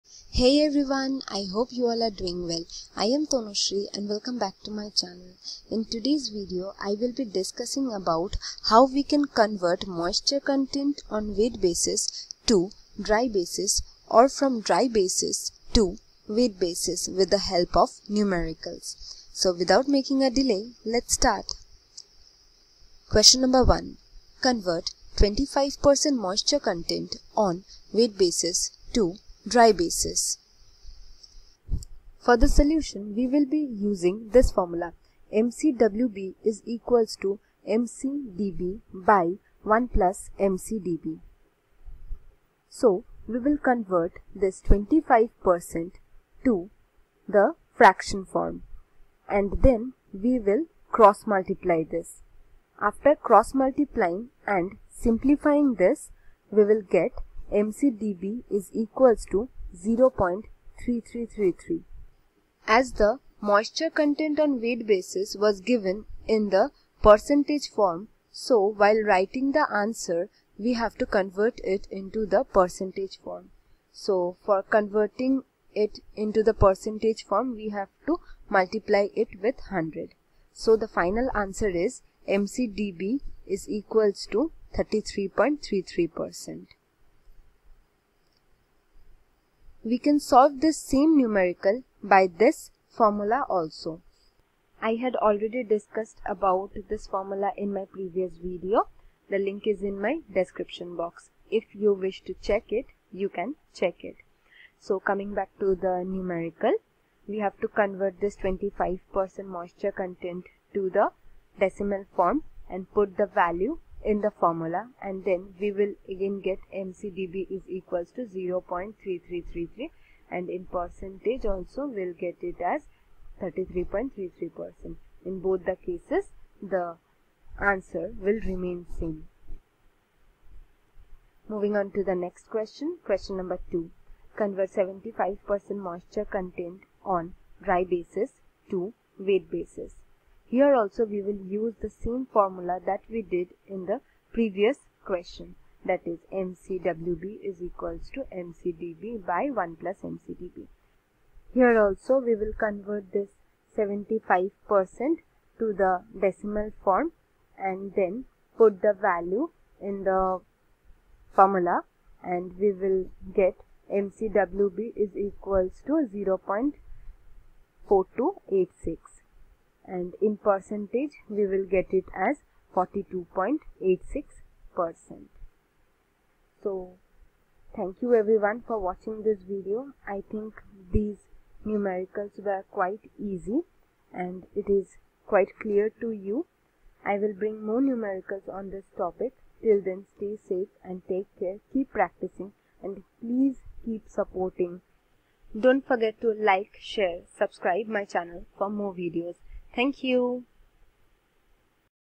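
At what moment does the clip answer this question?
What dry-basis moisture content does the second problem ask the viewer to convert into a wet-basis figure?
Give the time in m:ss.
2:14.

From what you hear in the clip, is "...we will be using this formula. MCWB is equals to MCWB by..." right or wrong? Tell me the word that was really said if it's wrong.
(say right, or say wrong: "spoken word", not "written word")
wrong: "MCDB", not "MCWB".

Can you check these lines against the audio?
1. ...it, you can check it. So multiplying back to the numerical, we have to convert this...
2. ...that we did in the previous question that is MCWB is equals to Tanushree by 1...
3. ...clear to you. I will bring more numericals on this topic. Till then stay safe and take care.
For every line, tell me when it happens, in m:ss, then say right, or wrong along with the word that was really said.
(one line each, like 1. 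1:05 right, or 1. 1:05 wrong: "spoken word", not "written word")
1. 1:42 wrong: "coming", not "multiplying"
2. 2:22 wrong: "MCDB", not "Tanushree"
3. 3:05 right.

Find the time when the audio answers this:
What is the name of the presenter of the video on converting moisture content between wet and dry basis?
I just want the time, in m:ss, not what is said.
0:03.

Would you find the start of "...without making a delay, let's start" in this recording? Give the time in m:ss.
0:19.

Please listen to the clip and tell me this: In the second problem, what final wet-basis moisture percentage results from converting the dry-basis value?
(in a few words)
42.86%.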